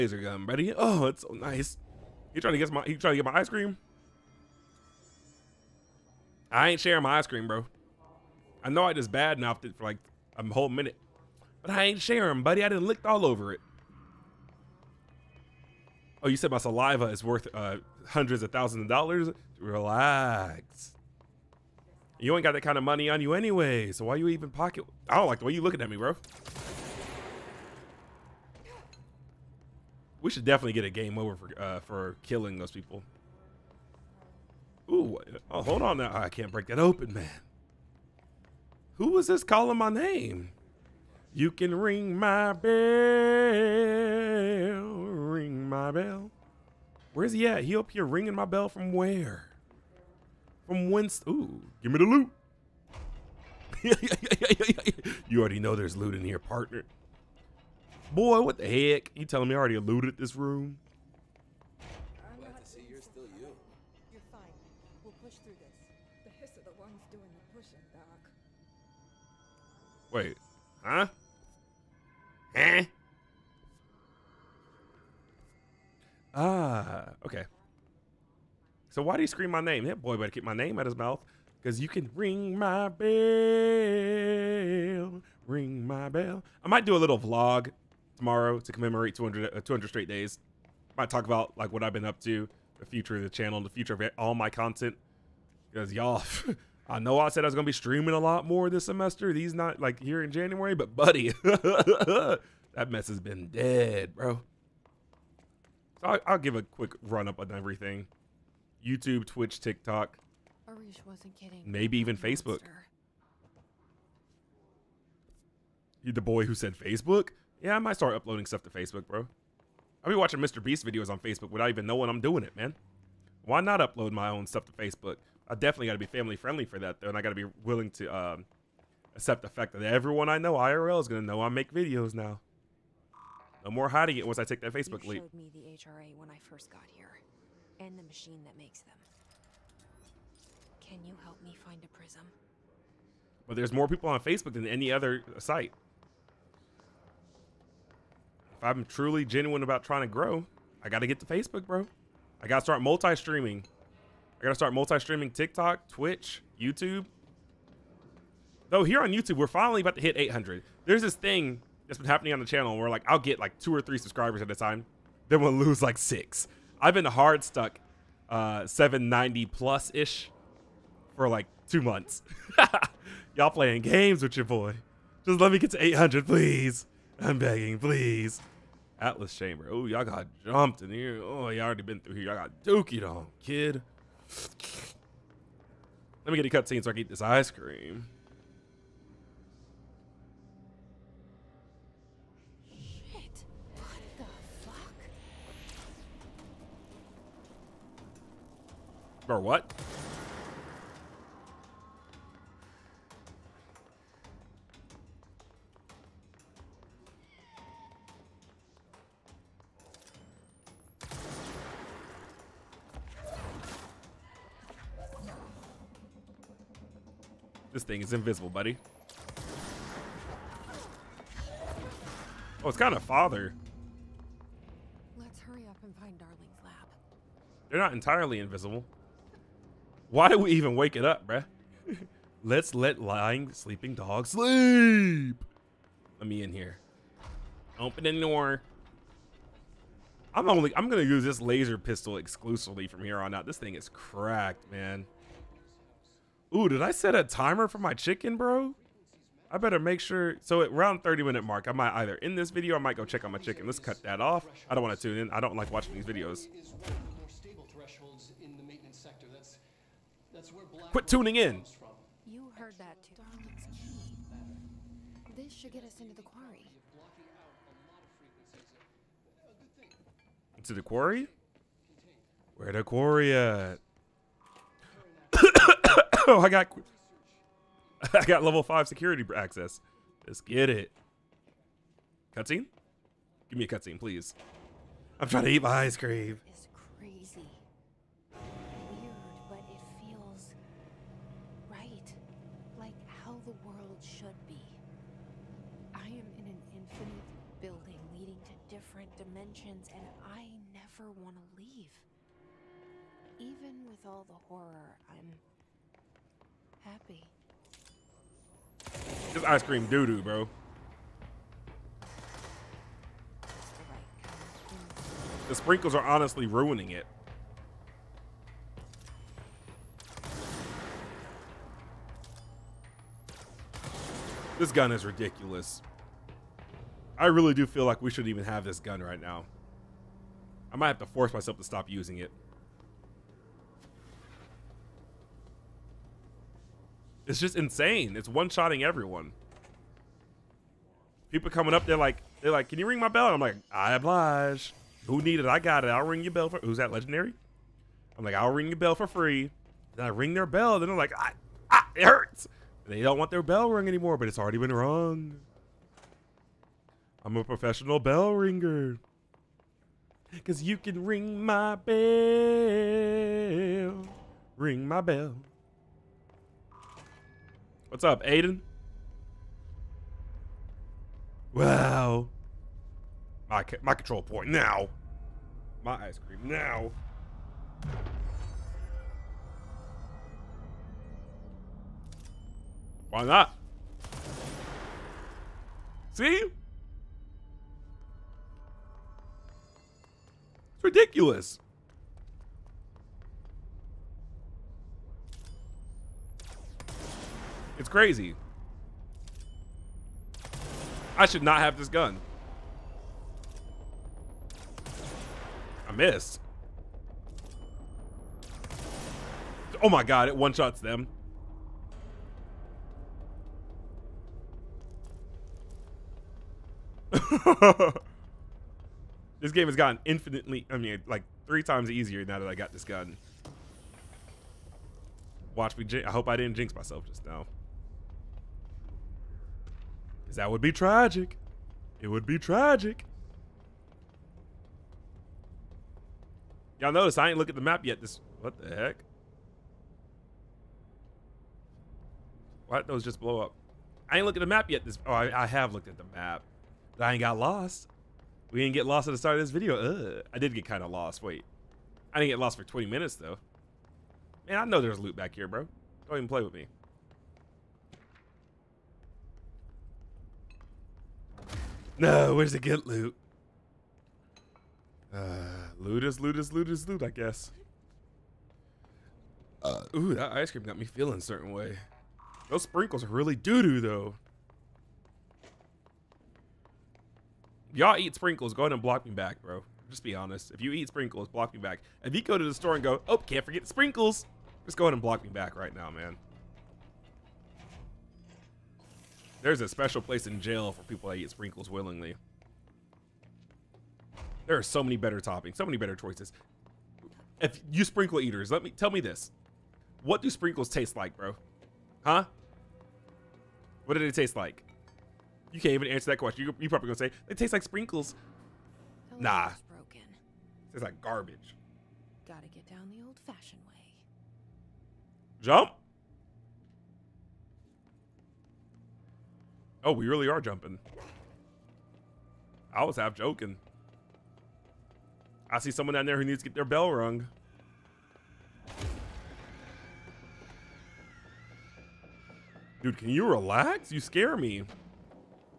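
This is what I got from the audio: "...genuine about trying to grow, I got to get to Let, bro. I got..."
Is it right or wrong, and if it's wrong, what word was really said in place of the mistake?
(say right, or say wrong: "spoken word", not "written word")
wrong: "Facebook", not "Let".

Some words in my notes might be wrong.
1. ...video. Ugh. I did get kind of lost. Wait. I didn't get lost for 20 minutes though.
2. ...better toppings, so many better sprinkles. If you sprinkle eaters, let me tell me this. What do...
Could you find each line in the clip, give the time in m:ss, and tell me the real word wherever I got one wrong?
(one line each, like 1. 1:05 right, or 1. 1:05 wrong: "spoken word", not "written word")
1. 7:29 right
2. 8:14 wrong: "choices", not "sprinkles".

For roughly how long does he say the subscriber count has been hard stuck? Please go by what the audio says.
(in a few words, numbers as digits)
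two months.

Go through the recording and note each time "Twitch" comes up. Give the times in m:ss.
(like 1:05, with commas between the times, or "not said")
1:49, 2:35.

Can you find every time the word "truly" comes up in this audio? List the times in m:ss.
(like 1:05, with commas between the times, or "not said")
2:28.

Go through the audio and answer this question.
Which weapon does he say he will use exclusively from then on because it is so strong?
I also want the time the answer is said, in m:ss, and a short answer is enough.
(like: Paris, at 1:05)
laser pistol, at 4:01.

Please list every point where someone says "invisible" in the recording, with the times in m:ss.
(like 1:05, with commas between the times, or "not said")
3:38, 3:48.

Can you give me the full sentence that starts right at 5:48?
I'm like, I'll ring your bell for free.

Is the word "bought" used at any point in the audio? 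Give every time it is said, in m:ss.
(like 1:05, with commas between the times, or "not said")
not said.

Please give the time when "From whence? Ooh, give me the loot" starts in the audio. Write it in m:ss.
0:50.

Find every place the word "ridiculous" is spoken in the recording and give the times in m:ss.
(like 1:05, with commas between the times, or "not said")
5:25, 6:30.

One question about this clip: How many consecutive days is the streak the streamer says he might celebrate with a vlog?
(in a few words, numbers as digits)
200.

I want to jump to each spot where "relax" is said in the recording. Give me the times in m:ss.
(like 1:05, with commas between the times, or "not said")
0:19, 8:53.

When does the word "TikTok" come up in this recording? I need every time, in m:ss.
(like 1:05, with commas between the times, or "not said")
1:49, 2:35.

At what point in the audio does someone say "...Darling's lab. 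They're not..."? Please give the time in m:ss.
3:46.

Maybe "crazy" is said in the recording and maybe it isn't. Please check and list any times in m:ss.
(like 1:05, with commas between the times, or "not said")
4:46, 6:37.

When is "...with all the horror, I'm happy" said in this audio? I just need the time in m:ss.
5:03.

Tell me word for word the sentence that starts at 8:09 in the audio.
There's a special place in jail for people that eat sprinkles willingly.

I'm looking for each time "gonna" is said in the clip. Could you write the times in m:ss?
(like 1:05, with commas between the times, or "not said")
1:37, 2:11, 4:00, 8:26.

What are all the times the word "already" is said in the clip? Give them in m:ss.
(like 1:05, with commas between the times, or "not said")
0:55, 0:59, 3:01, 5:54.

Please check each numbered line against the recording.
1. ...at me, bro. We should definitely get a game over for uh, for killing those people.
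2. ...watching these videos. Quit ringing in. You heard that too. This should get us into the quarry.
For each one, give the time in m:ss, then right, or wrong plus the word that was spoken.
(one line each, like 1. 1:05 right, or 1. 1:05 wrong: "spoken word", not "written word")
1. 0:25 right
2. 4:15 wrong: "tuning", not "ringing".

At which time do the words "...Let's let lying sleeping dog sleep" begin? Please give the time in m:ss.
3:52.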